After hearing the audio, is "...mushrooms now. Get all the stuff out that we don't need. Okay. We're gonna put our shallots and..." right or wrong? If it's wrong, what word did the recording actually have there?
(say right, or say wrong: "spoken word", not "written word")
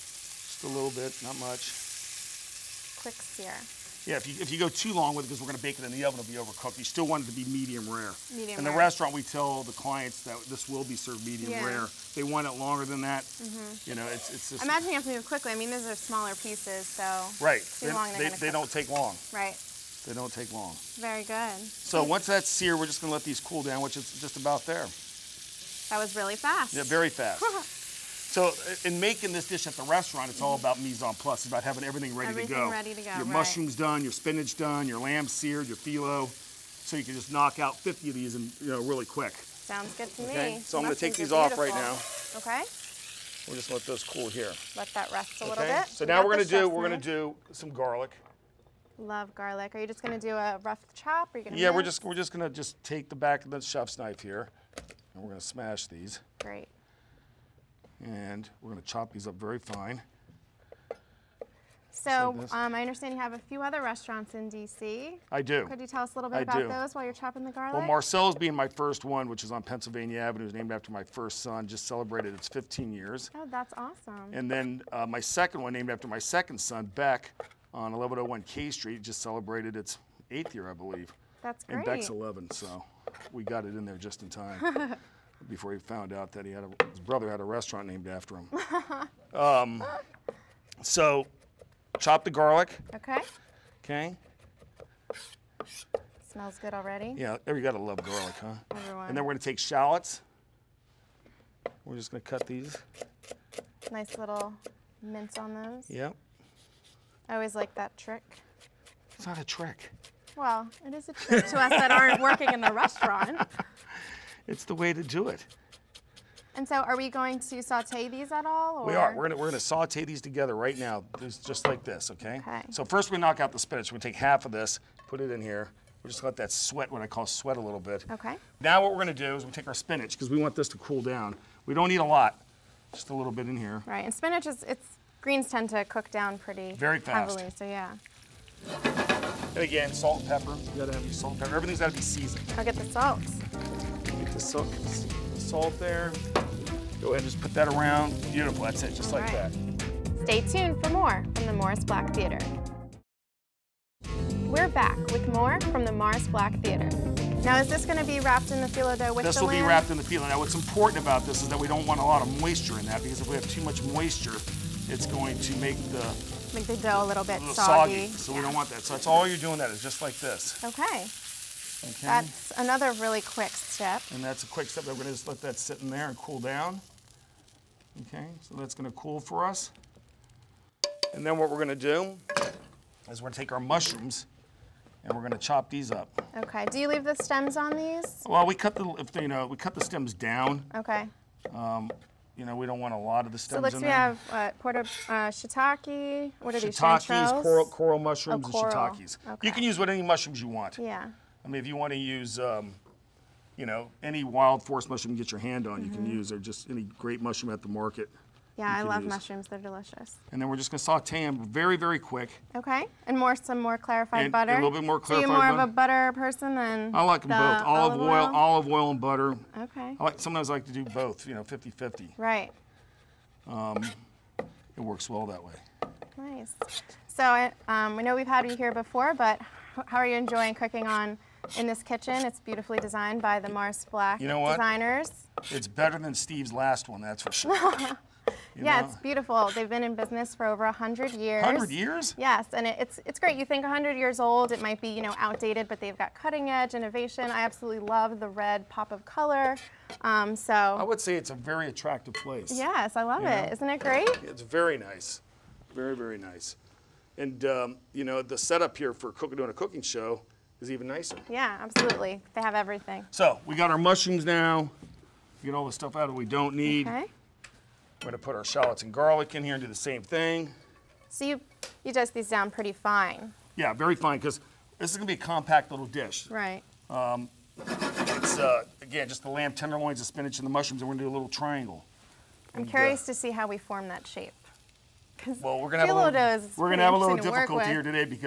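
right.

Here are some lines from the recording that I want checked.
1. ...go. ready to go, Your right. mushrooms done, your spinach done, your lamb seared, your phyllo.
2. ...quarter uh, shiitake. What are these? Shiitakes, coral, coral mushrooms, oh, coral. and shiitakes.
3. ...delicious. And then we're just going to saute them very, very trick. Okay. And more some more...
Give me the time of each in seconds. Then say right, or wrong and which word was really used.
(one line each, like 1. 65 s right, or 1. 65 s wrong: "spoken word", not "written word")
1. 32 s right
2. 194 s right
3. 209 s wrong: "quick", not "trick".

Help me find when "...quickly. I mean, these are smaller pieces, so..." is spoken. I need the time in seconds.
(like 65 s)
15 s.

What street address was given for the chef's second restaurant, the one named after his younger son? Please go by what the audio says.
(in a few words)
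1101 K Street.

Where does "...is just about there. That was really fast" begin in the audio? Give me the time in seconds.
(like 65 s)
23 s.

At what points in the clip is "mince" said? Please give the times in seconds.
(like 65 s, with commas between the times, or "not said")
51 s, 105 s.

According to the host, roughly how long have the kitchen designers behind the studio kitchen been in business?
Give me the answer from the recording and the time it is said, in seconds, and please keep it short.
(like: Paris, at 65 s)
Over 100 years, at 240 s.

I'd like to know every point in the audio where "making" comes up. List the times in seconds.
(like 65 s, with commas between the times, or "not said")
28 s.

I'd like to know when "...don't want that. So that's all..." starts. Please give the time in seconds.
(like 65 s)
168 s.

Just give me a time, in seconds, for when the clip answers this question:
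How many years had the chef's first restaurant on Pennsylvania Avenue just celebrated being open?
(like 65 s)
72 s.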